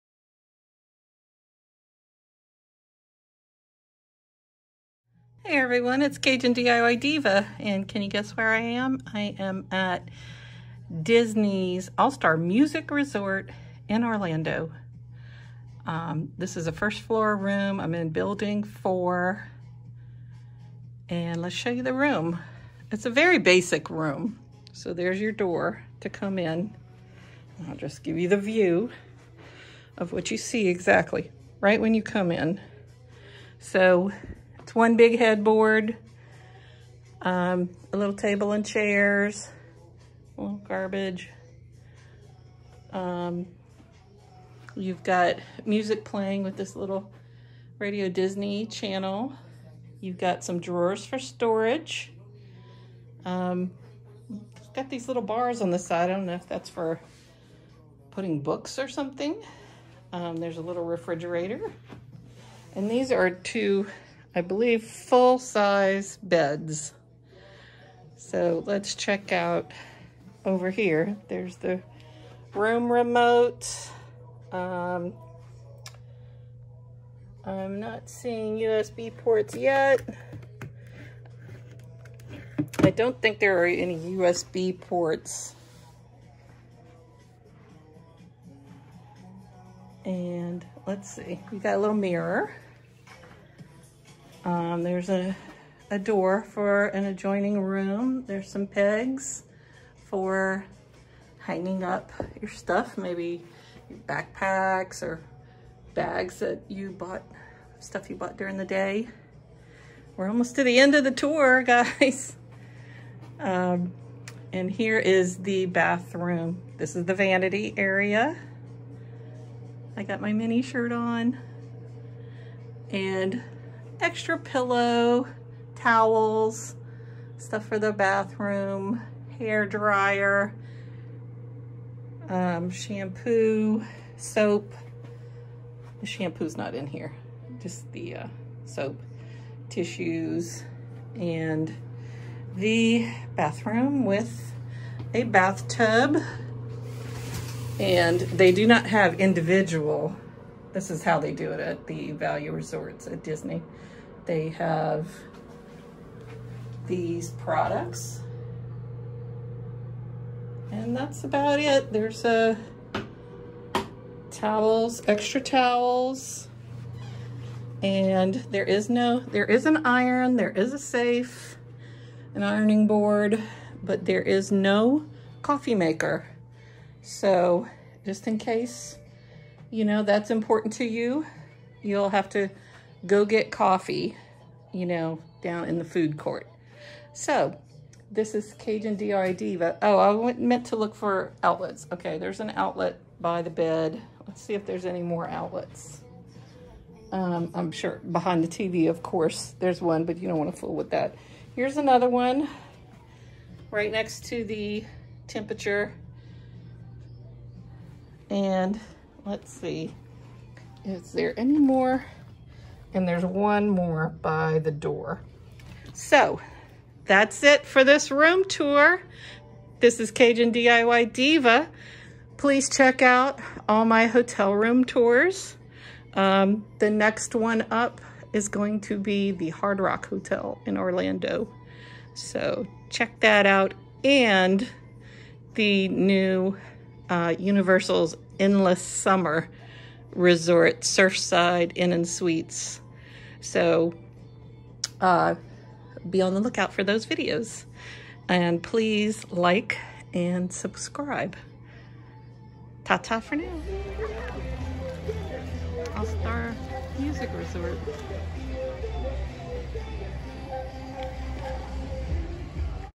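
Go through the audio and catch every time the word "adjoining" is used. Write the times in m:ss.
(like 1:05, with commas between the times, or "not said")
1:37.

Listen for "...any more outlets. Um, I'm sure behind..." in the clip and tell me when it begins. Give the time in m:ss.
3:14.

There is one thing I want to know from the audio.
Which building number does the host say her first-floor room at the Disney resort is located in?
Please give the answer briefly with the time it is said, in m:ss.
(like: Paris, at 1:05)
4, at 0:18.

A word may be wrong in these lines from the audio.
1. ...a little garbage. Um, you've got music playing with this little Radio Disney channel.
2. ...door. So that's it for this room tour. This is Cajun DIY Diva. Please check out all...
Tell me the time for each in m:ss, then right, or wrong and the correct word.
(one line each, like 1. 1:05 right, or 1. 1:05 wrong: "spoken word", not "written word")
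1. 0:40 right
2. 3:34 right.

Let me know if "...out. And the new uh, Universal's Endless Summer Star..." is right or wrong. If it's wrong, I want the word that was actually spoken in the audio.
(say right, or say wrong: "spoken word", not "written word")
wrong: "Resort", not "Star".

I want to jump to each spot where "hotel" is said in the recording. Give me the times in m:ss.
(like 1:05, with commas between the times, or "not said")
3:44, 3:50.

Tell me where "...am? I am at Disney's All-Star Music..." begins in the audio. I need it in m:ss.
0:08.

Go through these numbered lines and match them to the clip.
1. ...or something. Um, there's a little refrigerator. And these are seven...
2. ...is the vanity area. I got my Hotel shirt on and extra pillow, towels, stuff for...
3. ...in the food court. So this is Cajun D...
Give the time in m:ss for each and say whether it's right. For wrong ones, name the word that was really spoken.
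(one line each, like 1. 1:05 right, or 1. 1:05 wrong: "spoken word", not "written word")
1. 0:58 wrong: "two", not "seven"
2. 1:56 wrong: "Minnie", not "Hotel"
3. 3:05 right.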